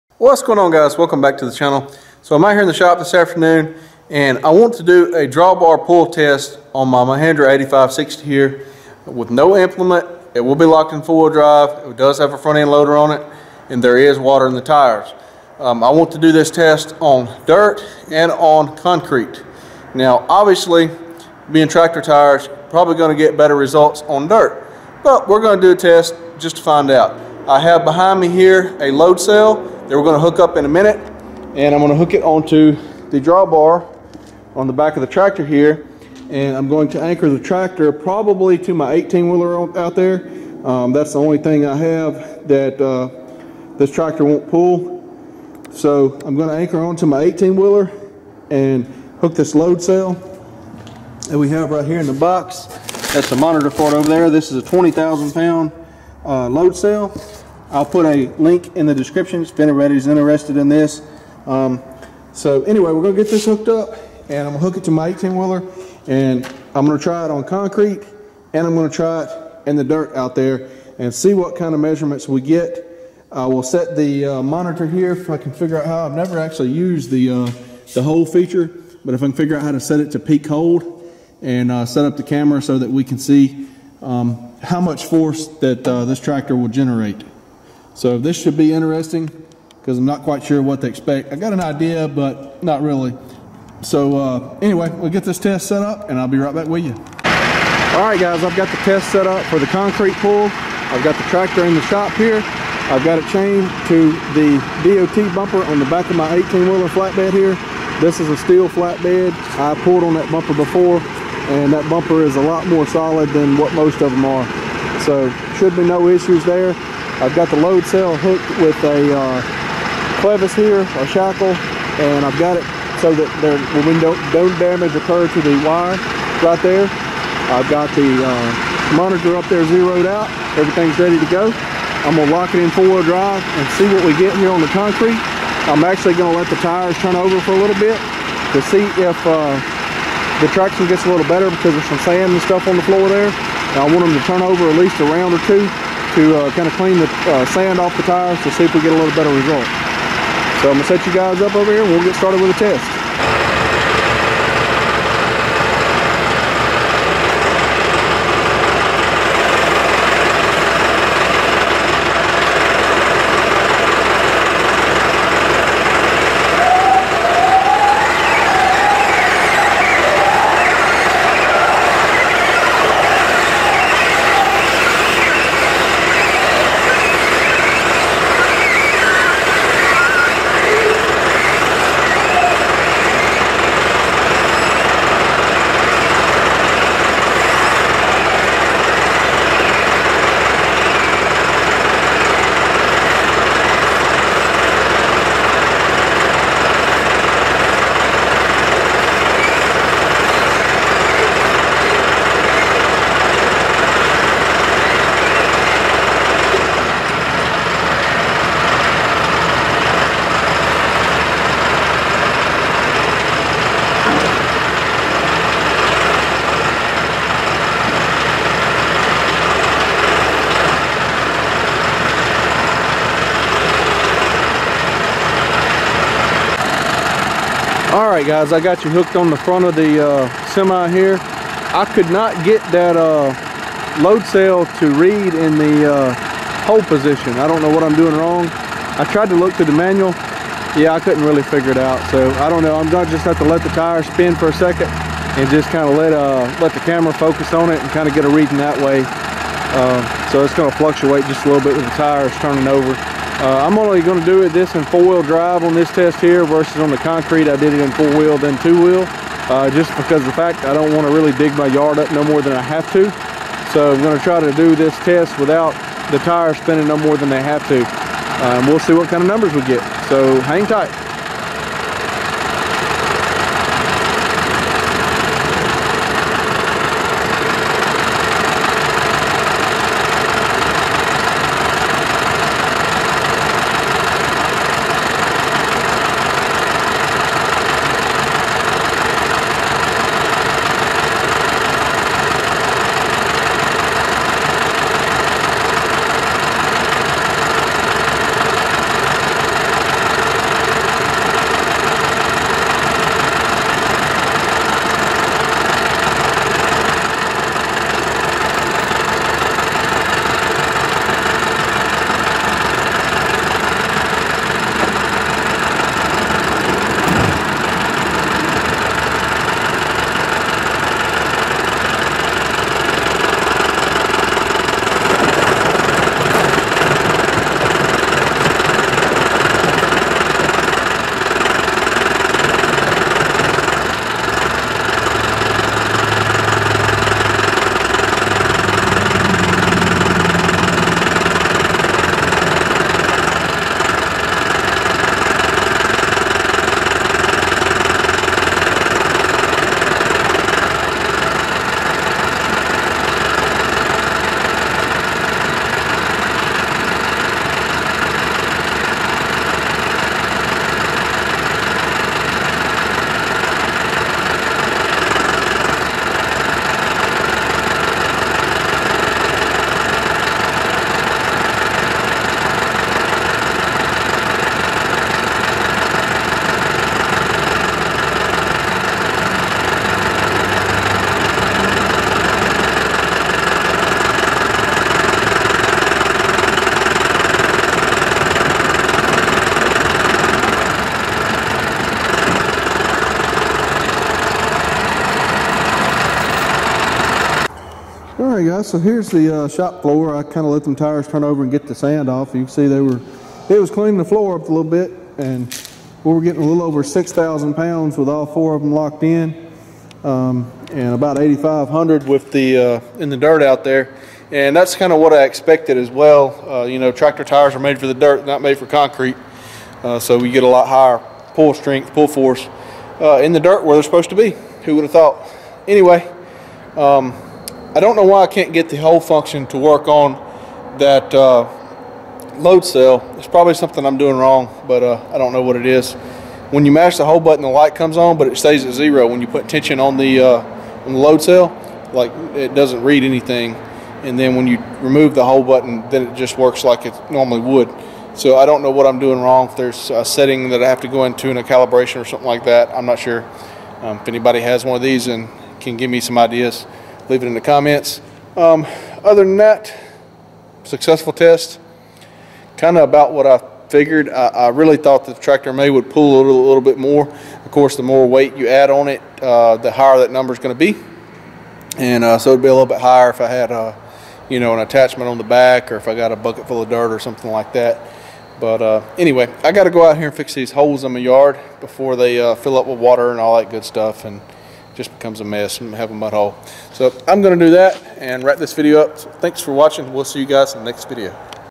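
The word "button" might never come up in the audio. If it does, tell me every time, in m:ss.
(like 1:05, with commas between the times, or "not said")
7:17, 7:25.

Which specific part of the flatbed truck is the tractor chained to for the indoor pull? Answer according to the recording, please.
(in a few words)
DOT bumper.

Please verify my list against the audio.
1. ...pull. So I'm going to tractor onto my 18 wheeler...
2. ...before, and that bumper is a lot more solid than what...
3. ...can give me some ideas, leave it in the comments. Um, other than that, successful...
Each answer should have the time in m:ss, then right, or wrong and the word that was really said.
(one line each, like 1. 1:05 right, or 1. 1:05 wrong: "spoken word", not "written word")
1. 0:44 wrong: "anchor", not "tractor"
2. 1:50 right
3. 7:35 right.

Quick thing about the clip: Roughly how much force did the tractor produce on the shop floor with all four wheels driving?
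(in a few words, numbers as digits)
a little over 6,000 pounds.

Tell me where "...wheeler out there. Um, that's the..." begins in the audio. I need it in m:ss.
0:39.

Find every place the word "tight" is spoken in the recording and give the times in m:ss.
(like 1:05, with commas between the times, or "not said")
4:30.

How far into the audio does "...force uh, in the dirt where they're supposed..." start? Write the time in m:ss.
7:02.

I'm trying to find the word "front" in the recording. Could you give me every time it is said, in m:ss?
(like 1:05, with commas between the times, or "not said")
0:12, 3:49.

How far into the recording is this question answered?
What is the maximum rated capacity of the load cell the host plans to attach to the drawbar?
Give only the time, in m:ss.
0:54.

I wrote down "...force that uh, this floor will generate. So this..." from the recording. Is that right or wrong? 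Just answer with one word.
wrong.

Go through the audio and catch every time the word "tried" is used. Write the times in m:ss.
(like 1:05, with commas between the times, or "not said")
3:59.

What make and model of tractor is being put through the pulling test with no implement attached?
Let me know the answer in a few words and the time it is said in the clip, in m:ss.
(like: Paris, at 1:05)
Mahindra 8560, at 0:07.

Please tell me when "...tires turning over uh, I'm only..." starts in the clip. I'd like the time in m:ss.
4:11.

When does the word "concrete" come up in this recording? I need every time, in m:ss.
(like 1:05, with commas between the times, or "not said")
0:18, 1:07, 1:39, 2:14, 4:16, 6:58.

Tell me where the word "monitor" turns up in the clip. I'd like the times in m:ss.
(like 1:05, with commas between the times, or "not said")
0:53, 1:14, 2:08.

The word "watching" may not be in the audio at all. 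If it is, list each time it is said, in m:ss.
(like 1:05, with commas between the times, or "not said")
8:09.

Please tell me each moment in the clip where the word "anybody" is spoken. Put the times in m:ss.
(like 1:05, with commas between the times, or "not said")
0:59, 7:34.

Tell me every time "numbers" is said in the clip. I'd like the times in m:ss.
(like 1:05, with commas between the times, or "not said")
4:29, 7:50.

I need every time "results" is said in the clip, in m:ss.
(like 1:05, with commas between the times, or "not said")
0:23, 2:29.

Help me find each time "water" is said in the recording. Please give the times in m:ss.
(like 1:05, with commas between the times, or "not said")
0:14, 8:02.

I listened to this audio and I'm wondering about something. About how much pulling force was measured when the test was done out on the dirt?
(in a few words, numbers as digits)
8,500 pounds.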